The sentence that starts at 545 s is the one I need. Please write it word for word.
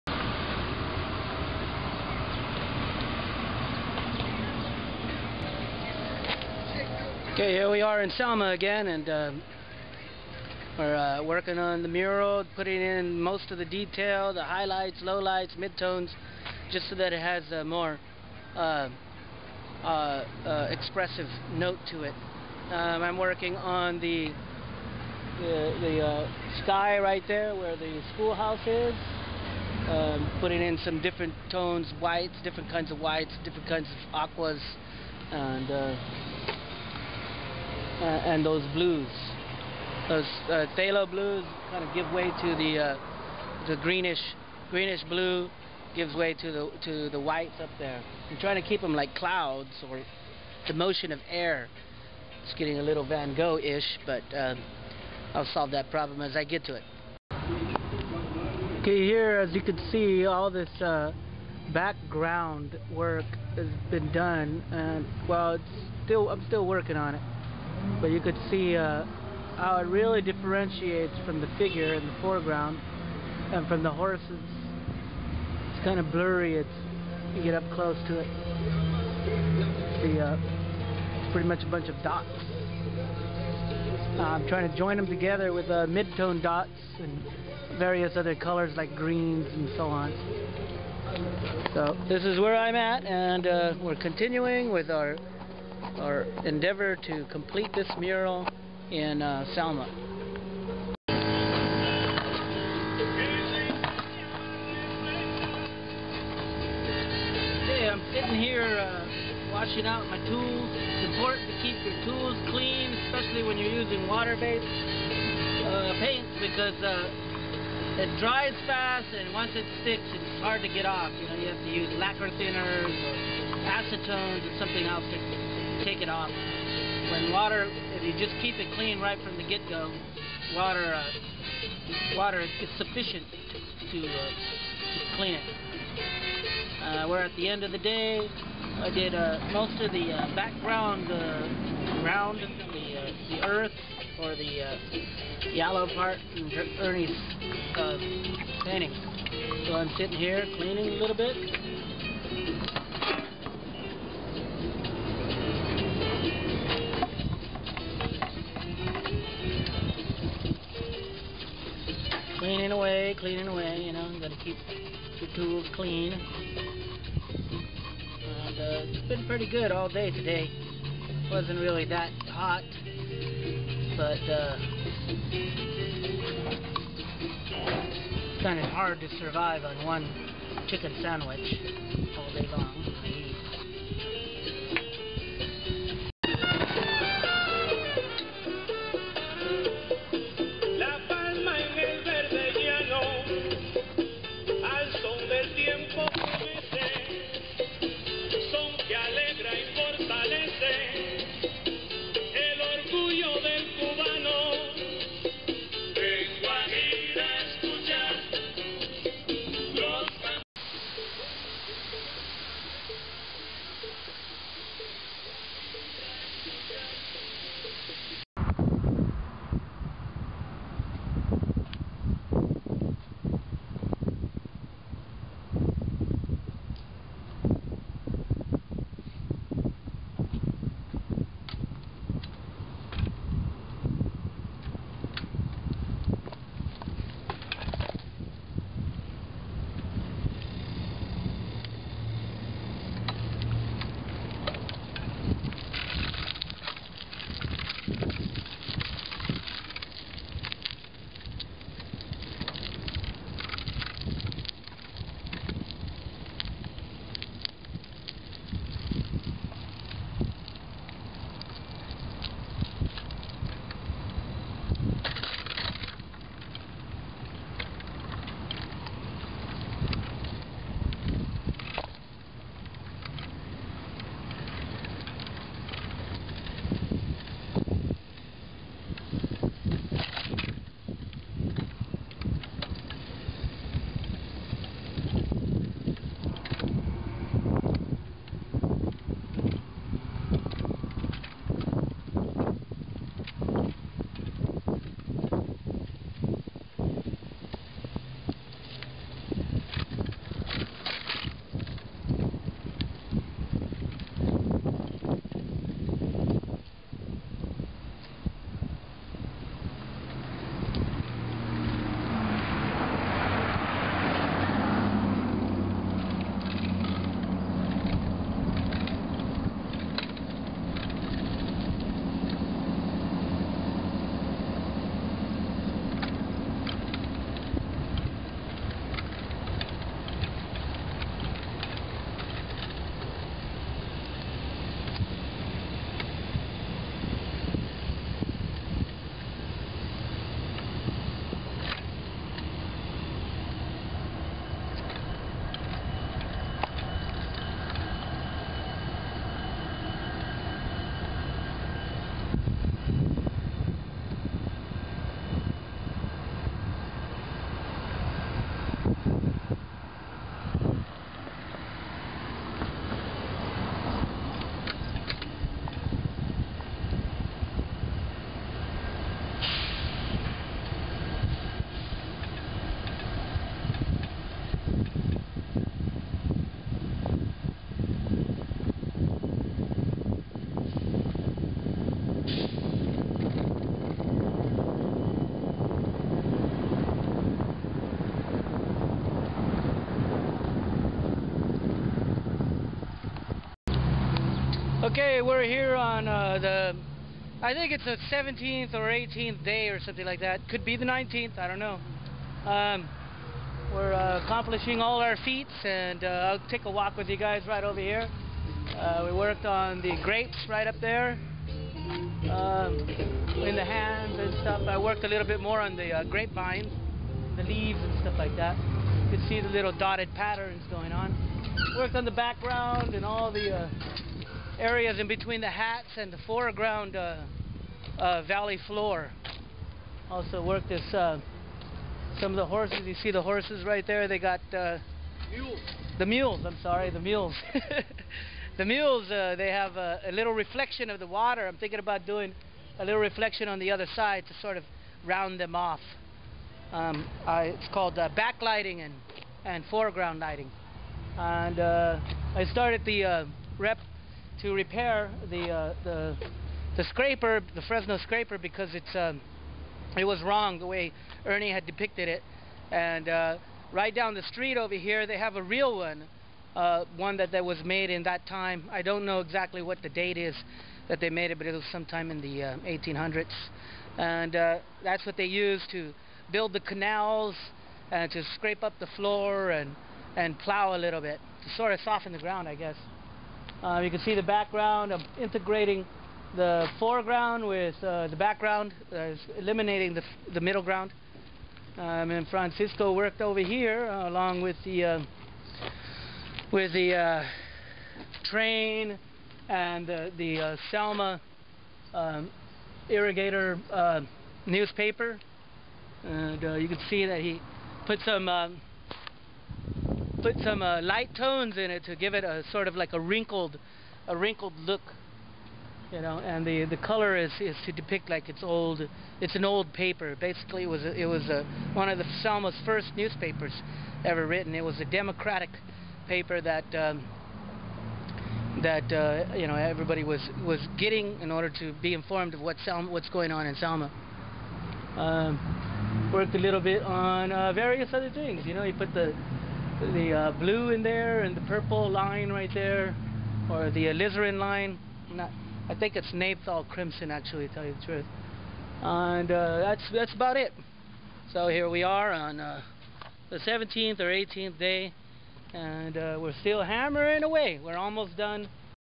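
Not, I think it's naphthol crimson, actually, to tell you the truth.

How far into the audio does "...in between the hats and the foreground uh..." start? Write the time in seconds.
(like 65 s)
424 s.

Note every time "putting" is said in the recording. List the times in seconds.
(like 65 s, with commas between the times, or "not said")
12 s, 30 s.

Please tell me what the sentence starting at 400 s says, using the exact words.
Could be the 19th, I don't know.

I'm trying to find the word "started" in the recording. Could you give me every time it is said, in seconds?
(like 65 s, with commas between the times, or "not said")
452 s.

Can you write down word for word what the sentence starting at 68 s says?
But you could see uh, how it really differentiates from the figure in the foreground and from the horses.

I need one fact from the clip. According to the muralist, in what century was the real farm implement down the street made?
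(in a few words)
1800s.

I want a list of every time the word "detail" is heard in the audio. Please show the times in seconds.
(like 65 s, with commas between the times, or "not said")
13 s.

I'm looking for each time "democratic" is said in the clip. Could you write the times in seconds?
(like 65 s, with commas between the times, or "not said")
524 s.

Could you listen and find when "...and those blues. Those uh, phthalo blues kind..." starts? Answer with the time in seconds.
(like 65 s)
38 s.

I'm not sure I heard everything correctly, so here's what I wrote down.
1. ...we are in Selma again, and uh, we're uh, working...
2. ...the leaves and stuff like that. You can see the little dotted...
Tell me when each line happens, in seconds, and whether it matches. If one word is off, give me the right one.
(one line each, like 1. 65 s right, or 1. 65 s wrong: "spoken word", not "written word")
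1. 7 s right
2. 417 s right.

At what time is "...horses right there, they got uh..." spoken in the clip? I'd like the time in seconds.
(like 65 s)
433 s.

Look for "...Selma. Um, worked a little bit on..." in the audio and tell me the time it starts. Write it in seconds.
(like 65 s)
533 s.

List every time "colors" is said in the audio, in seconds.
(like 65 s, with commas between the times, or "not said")
88 s, 516 s.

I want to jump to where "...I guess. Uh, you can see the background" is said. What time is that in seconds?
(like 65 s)
482 s.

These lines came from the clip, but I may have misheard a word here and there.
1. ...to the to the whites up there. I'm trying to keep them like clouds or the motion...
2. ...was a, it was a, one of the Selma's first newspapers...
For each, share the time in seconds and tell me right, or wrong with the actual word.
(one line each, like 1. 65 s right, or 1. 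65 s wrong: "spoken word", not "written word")
1. 46 s right
2. 520 s right.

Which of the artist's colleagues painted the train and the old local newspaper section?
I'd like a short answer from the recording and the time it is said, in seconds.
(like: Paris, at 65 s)
Francisco, at 492 s.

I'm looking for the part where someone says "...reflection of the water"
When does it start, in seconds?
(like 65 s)
440 s.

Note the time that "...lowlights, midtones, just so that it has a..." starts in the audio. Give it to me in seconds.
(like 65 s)
15 s.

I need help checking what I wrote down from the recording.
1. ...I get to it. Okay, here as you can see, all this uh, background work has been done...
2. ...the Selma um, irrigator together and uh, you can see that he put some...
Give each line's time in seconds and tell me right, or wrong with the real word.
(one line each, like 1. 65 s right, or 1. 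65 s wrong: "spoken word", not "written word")
1. 56 s right
2. 499 s wrong: "newspaper", not "together".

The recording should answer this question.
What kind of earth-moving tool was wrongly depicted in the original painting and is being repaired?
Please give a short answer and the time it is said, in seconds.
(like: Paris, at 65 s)
Fresno scraper, at 457 s.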